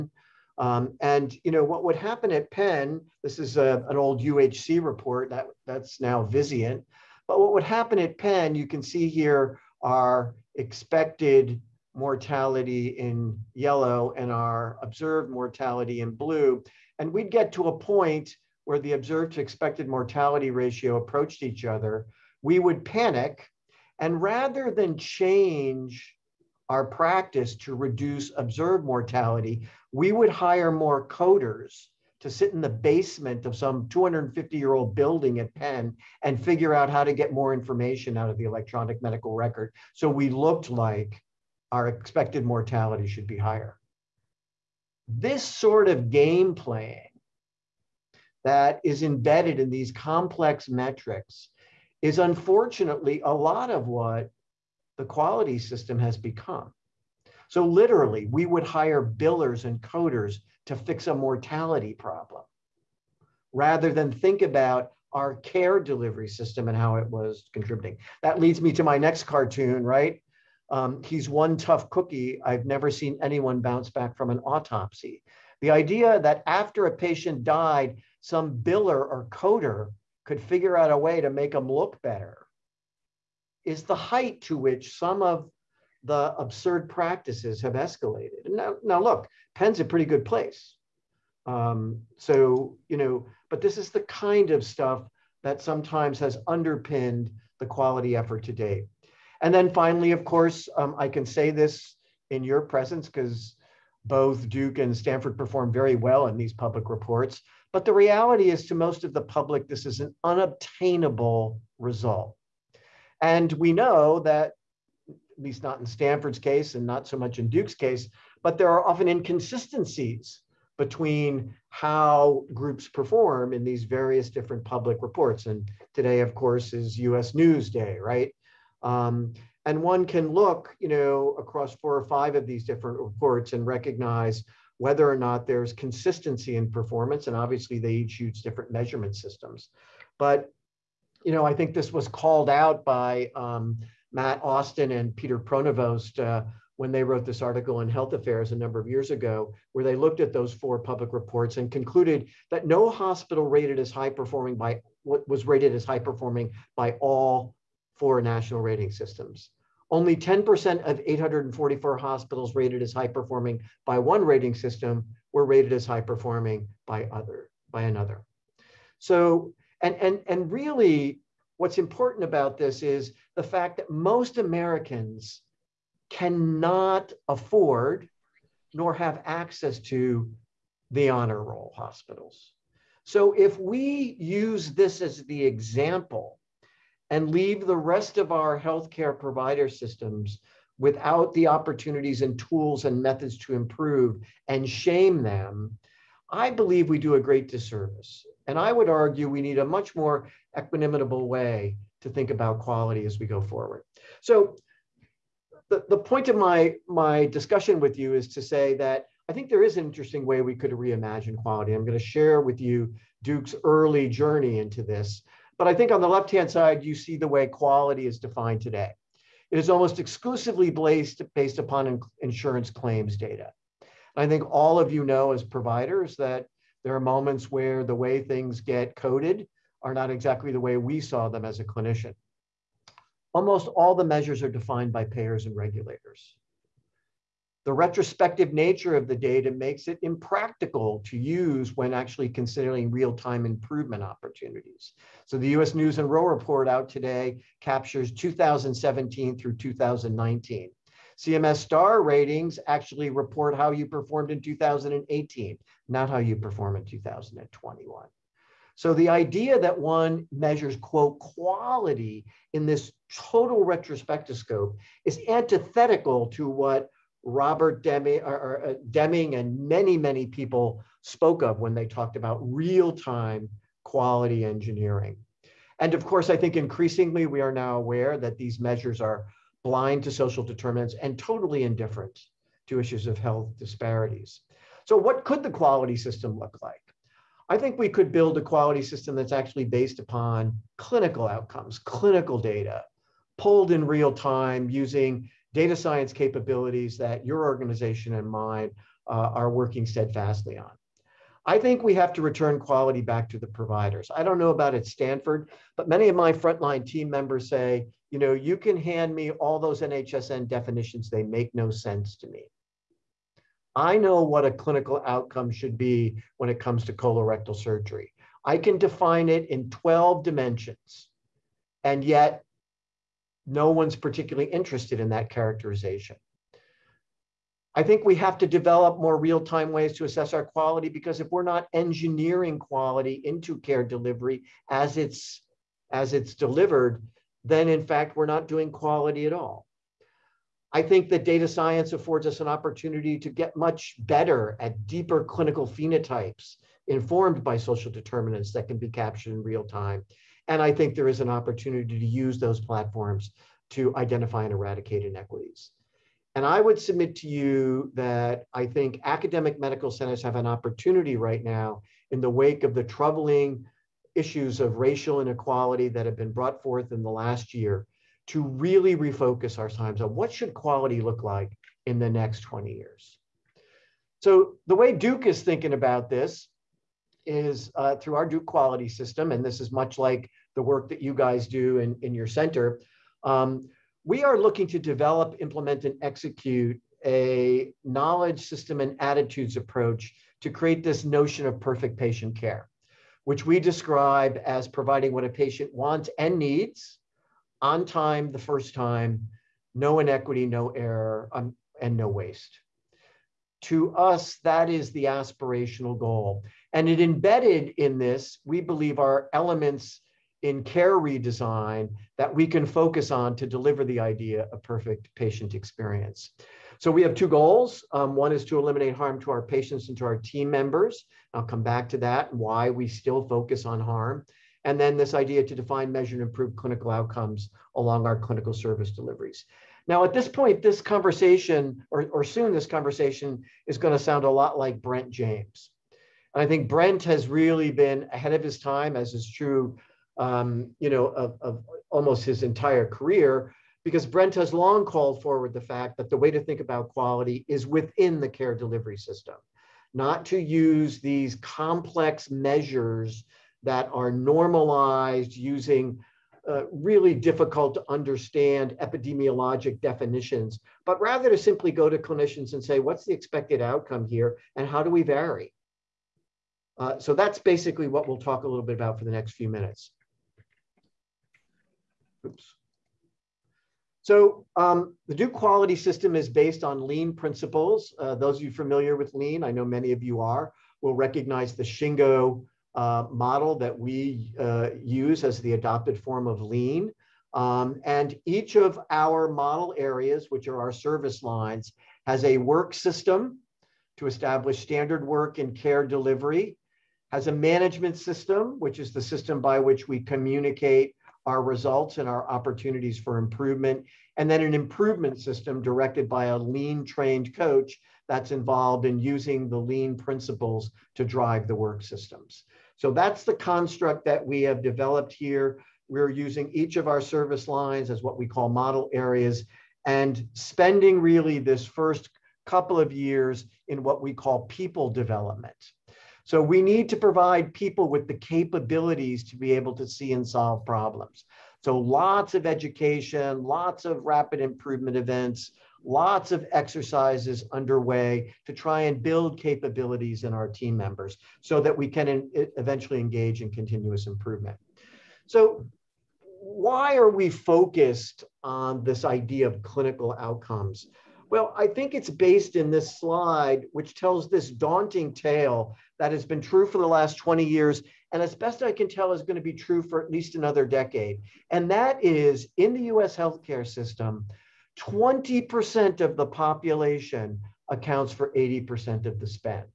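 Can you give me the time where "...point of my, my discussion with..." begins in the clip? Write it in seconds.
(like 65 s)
205 s.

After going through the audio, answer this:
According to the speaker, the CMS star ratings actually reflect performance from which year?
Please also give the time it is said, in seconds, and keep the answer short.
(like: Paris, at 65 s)
2018, at 254 s.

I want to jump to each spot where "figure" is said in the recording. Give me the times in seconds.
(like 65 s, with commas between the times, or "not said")
36 s, 80 s.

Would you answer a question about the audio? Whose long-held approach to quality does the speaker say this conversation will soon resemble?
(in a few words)
Brent James.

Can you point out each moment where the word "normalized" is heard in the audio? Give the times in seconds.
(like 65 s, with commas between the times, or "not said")
454 s.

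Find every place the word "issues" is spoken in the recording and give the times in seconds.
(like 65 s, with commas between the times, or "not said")
282 s, 364 s.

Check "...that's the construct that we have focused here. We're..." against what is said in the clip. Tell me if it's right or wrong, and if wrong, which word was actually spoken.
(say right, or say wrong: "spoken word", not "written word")
wrong: "developed", not "focused".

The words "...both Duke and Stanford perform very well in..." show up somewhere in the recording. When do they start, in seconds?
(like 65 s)
104 s.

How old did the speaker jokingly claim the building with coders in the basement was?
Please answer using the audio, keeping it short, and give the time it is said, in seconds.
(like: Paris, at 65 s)
250 years, at 33 s.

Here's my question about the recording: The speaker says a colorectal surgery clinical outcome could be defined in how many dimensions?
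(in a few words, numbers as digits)
12.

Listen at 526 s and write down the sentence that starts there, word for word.
So we need to provide people with the capabilities to be able to see and solve problems.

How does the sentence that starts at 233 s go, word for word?
Almost all the measures are defined by payers and regulators.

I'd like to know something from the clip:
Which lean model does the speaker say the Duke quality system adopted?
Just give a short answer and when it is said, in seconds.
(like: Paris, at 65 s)
Shingo, at 481 s.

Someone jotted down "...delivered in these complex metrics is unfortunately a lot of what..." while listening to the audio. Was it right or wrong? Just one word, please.
wrong.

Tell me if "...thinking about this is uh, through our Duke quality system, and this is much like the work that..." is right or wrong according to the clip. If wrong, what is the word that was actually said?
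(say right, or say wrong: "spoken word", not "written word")
right.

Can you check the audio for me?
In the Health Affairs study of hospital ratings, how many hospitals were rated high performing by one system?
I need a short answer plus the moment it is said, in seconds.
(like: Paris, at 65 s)
844, at 161 s.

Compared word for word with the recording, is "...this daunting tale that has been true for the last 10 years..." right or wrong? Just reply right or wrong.
wrong.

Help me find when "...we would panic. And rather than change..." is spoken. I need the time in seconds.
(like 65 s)
22 s.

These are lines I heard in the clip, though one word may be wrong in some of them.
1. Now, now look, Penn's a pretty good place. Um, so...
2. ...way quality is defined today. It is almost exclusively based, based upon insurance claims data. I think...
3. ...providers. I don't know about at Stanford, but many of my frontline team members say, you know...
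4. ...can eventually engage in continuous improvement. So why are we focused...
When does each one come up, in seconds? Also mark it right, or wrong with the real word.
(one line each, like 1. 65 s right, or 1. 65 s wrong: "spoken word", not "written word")
1. 88 s right
2. 217 s right
3. 303 s right
4. 541 s right.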